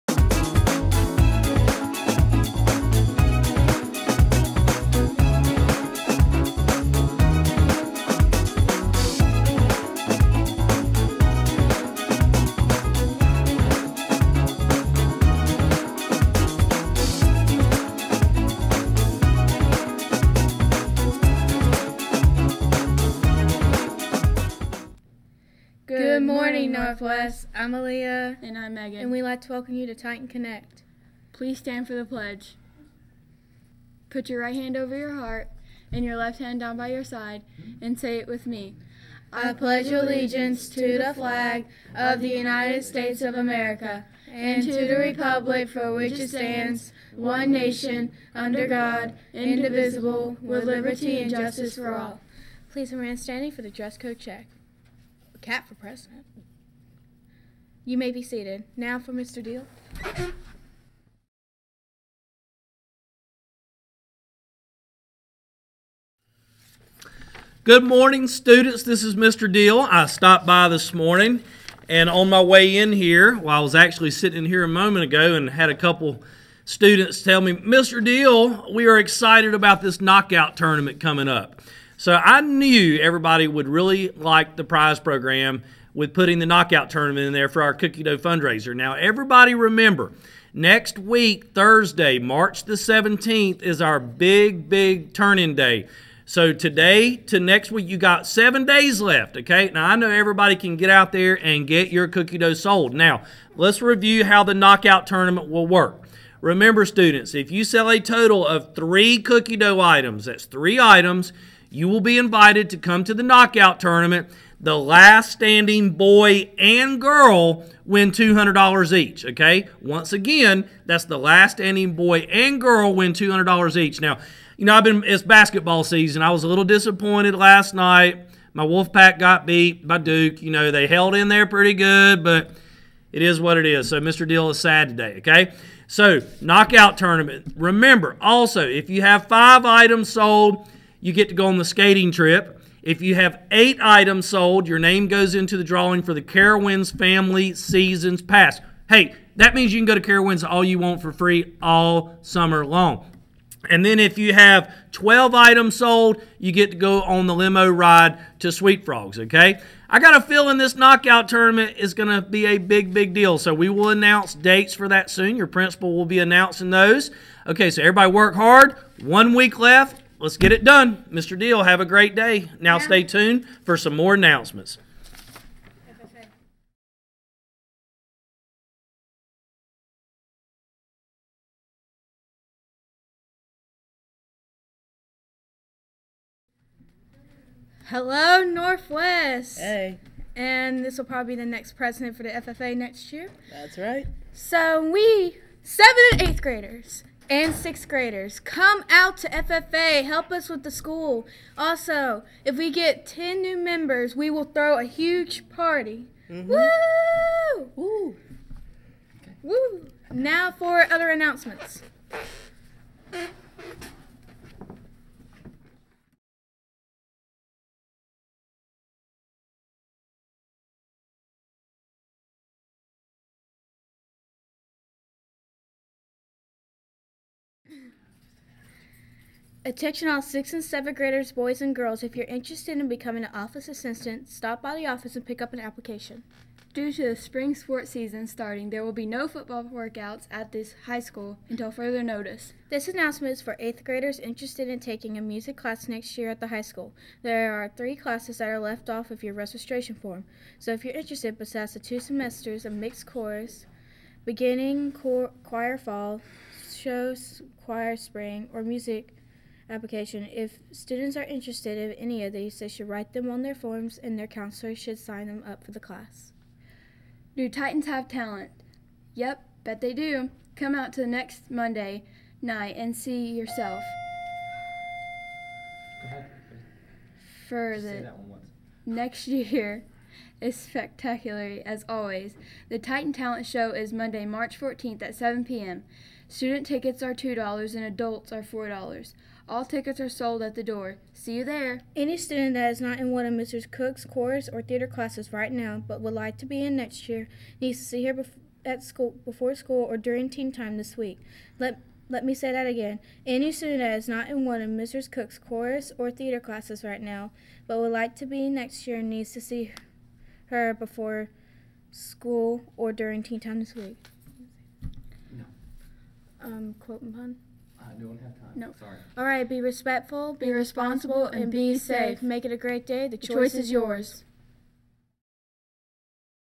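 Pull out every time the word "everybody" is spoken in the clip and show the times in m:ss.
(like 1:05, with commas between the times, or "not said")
1:22, 1:28, 1:40, 2:47.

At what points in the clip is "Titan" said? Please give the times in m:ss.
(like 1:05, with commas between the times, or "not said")
0:29, 4:27, 4:42.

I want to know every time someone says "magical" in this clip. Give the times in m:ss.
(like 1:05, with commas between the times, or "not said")
not said.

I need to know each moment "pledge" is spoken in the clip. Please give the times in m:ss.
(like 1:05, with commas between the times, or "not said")
0:32, 0:39.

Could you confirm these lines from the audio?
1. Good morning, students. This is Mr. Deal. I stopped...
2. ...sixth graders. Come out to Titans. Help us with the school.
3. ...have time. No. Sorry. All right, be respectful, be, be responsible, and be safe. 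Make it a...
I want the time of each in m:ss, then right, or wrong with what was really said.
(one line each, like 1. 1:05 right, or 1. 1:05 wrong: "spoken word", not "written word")
1. 1:07 right
2. 3:17 wrong: "FFA", not "Titans"
3. 5:18 right.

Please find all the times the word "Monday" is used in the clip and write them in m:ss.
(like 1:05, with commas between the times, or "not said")
4:31, 4:43.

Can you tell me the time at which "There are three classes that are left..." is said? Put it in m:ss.
4:07.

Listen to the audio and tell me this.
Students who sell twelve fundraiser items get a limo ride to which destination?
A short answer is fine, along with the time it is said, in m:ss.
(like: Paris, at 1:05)
Sweet Frogs, at 2:38.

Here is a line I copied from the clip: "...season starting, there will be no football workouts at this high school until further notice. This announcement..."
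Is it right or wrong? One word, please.
right.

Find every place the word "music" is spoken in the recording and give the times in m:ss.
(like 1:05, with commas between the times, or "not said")
4:05, 4:18.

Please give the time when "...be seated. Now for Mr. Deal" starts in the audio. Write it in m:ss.
0:58.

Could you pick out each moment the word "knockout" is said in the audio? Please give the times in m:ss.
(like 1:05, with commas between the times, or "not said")
1:19, 1:26, 1:44, 1:53, 2:16, 2:40.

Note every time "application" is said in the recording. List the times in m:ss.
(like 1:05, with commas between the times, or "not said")
3:55, 4:19.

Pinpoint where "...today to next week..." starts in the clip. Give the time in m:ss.
1:36.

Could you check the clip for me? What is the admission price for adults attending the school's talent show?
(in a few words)
$4.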